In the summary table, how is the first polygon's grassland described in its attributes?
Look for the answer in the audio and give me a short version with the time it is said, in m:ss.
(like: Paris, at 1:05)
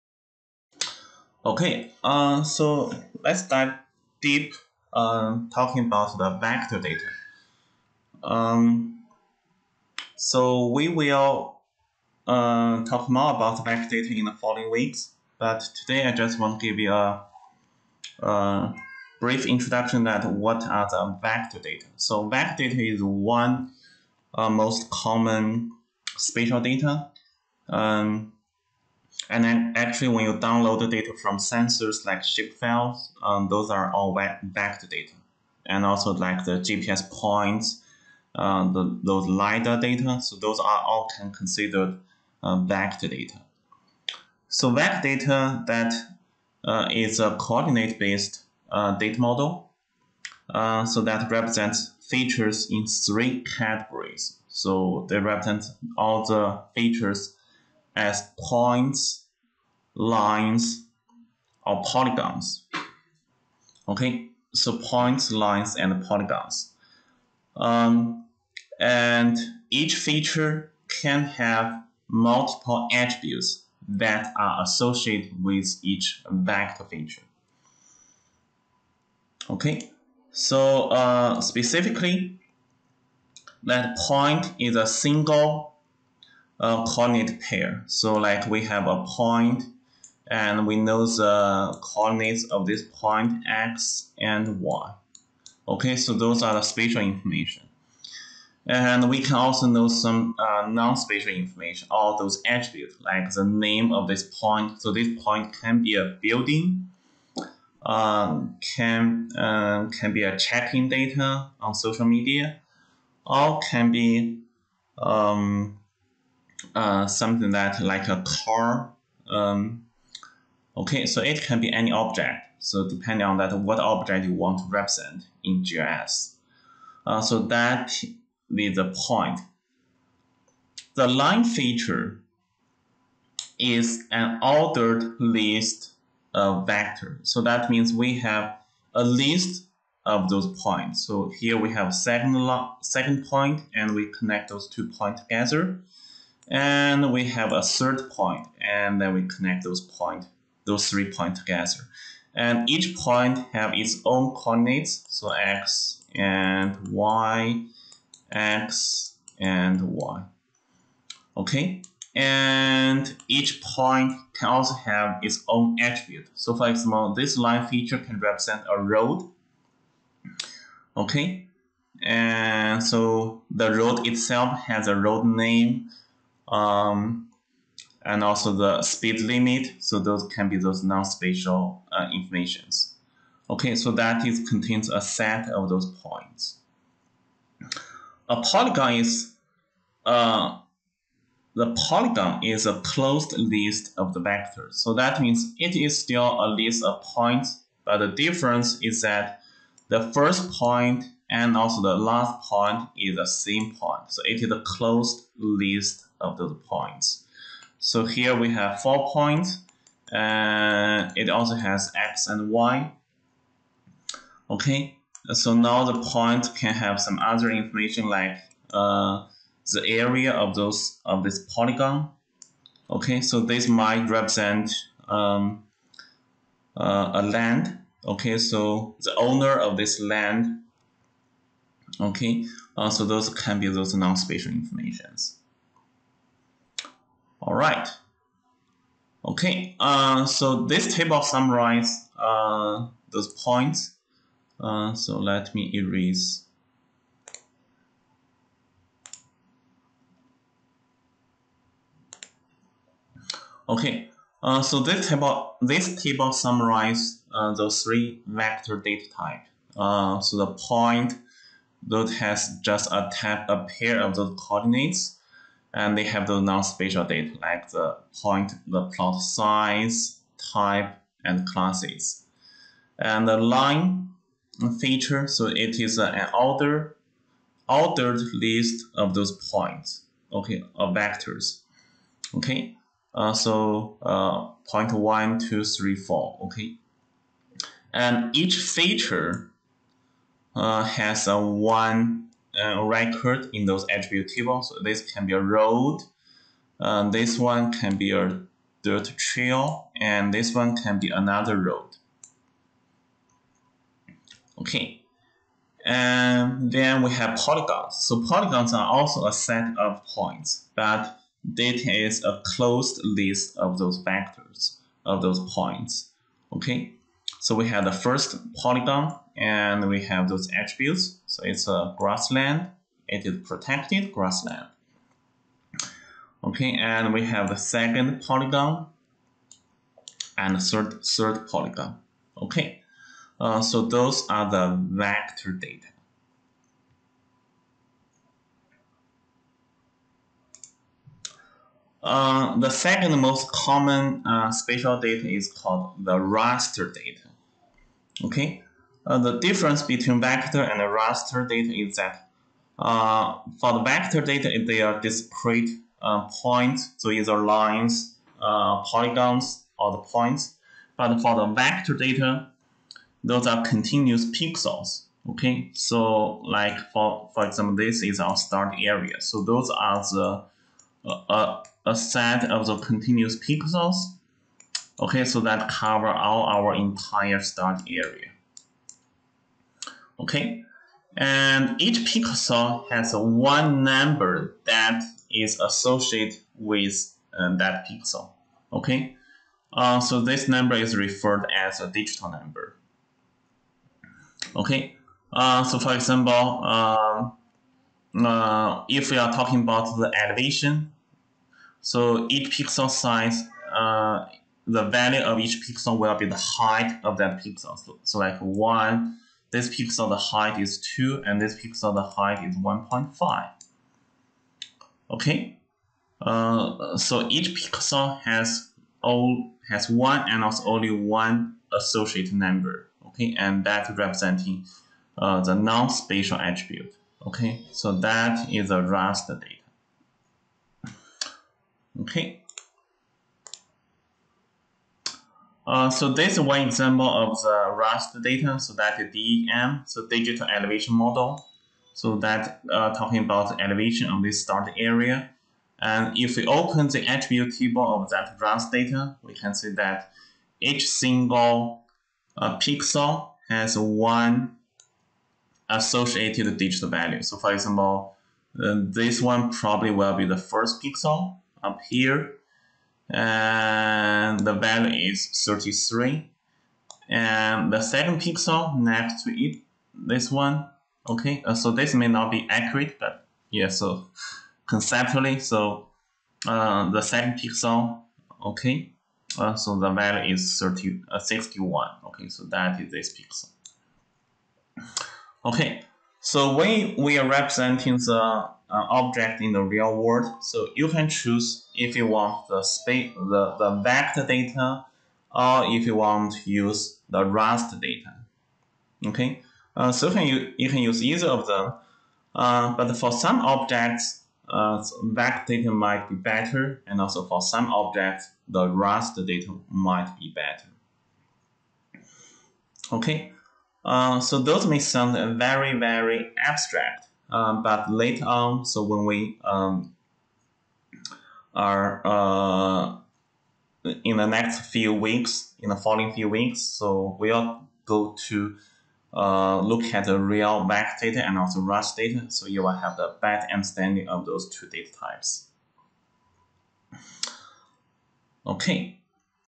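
protected grassland, at 5:23.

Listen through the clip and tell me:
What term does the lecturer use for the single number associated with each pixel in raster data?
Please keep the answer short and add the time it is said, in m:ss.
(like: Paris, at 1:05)
digital number, at 6:31.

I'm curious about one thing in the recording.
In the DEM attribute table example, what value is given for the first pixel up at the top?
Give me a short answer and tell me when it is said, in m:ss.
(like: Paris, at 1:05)
33, at 7:45.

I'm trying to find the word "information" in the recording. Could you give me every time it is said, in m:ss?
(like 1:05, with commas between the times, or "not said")
1:37, 1:41, 3:02, 3:37, 3:54.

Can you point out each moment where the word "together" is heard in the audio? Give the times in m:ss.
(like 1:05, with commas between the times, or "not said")
2:25, 2:31.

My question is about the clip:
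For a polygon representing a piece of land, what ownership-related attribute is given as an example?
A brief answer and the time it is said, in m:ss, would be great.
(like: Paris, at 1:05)
the owner, at 3:49.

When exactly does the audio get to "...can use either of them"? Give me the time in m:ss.
8:20.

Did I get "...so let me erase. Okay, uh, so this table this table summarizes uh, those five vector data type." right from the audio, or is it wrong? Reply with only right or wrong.
wrong.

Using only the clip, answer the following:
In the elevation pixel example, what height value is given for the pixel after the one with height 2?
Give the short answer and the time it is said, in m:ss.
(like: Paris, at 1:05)
1.5, at 6:52.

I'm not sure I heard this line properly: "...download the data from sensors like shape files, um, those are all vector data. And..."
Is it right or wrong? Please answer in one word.
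right.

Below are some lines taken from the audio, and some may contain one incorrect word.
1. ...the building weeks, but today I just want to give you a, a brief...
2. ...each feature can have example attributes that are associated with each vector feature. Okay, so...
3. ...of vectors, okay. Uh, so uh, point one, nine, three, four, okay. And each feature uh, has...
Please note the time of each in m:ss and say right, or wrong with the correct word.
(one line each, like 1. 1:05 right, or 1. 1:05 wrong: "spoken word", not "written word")
1. 0:14 wrong: "following", not "building"
2. 1:09 wrong: "multiple", not "example"
3. 4:40 wrong: "two", not "nine".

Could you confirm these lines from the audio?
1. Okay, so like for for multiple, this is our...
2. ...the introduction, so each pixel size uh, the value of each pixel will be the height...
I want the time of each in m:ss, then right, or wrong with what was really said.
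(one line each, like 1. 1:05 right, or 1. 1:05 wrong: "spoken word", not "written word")
1. 6:05 wrong: "example", not "multiple"
2. 6:39 wrong: "elevation", not "introduction".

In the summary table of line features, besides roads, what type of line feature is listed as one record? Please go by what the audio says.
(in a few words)
dirt trail.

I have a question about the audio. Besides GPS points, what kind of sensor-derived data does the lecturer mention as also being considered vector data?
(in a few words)
LiDAR data.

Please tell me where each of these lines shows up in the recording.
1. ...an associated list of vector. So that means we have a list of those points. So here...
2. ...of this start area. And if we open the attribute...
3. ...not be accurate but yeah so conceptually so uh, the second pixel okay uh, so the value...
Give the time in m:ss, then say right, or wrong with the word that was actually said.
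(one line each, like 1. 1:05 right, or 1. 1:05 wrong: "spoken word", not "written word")
1. 2:14 wrong: "ordered", not "associated"
2. 7:24 right
3. 7:52 right.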